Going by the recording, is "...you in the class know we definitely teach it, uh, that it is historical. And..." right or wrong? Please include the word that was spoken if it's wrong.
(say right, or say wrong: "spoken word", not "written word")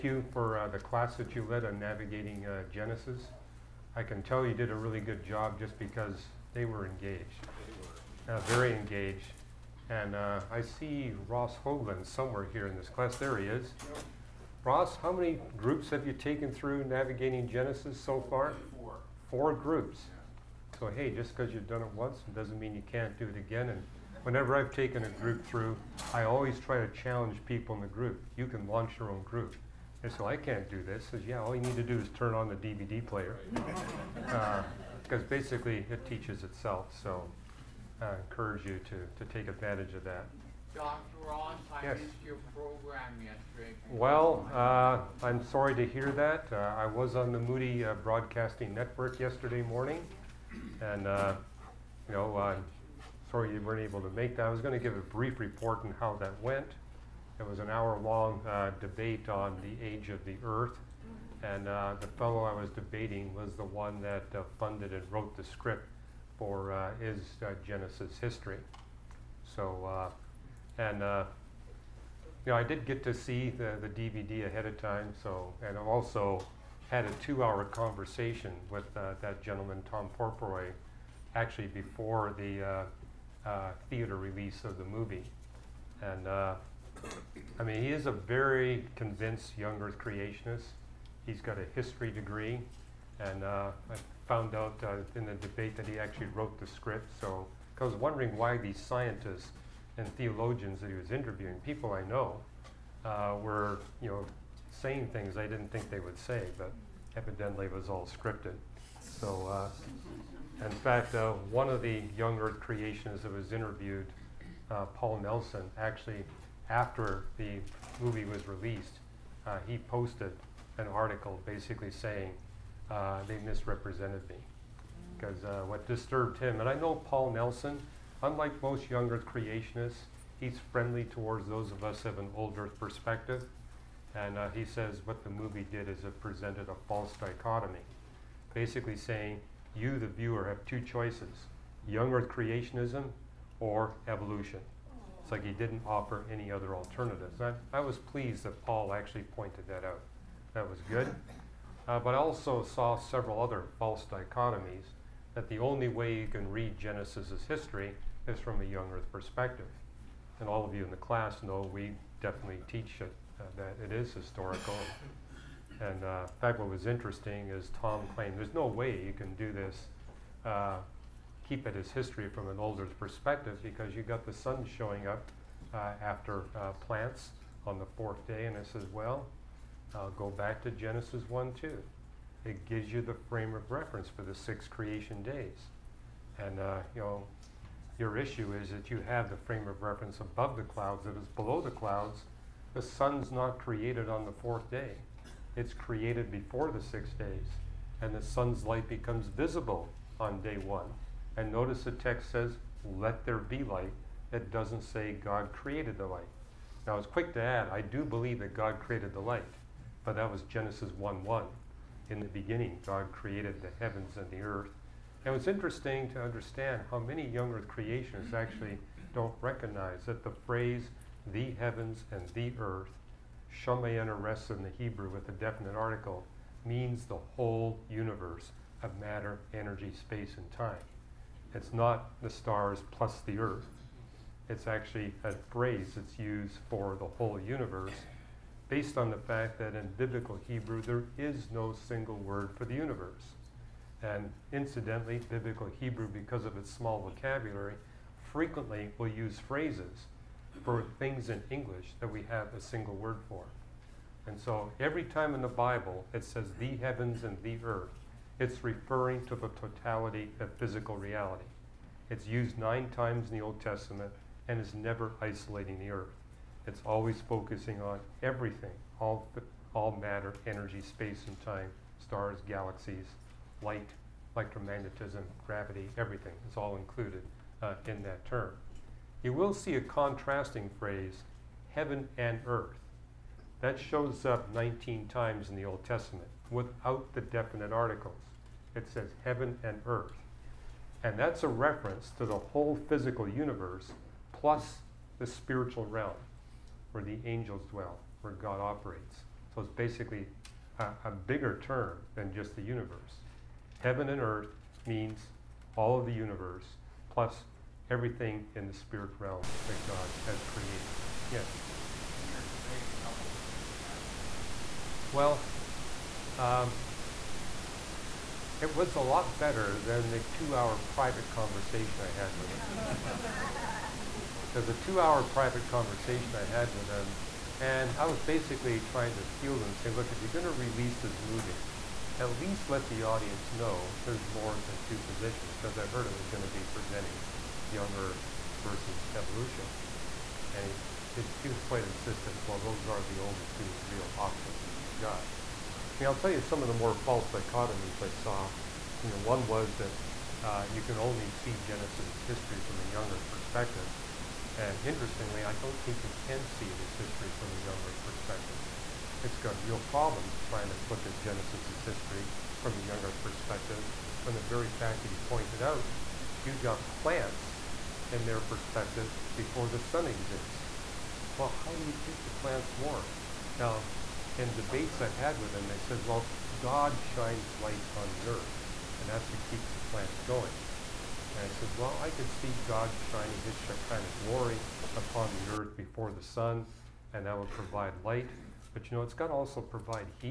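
right.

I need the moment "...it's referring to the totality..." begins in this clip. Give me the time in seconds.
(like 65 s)
258 s.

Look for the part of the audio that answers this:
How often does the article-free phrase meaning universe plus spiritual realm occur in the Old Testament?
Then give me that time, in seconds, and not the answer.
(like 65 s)
284 s.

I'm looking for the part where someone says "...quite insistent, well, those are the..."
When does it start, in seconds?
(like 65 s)
341 s.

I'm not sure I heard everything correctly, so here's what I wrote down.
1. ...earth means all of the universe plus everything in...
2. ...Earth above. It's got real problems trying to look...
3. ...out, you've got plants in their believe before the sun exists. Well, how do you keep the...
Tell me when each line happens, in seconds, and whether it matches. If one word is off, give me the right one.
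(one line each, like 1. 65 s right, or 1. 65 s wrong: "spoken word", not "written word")
1. 304 s right
2. 357 s wrong: "perspective", not "above"
3. 365 s wrong: "perspective", not "believe".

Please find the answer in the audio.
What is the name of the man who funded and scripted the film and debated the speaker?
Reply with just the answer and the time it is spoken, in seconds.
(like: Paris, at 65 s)
Tom Purifoy, at 79 s.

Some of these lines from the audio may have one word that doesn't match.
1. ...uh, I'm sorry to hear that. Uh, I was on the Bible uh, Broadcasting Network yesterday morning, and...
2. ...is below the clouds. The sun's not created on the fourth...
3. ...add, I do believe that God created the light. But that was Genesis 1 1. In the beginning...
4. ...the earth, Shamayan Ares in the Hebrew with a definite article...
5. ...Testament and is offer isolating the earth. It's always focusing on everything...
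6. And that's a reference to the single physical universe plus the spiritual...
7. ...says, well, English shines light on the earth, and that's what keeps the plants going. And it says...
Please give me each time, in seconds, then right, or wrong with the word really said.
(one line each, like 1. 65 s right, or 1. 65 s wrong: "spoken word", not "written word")
1. 44 s wrong: "Moody", not "Bible"
2. 191 s right
3. 207 s right
4. 222 s right
5. 263 s wrong: "never", not "offer"
6. 291 s wrong: "whole", not "single"
7. 375 s wrong: "God", not "English".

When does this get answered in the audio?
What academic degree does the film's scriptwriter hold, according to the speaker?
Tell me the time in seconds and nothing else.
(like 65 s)
91 s.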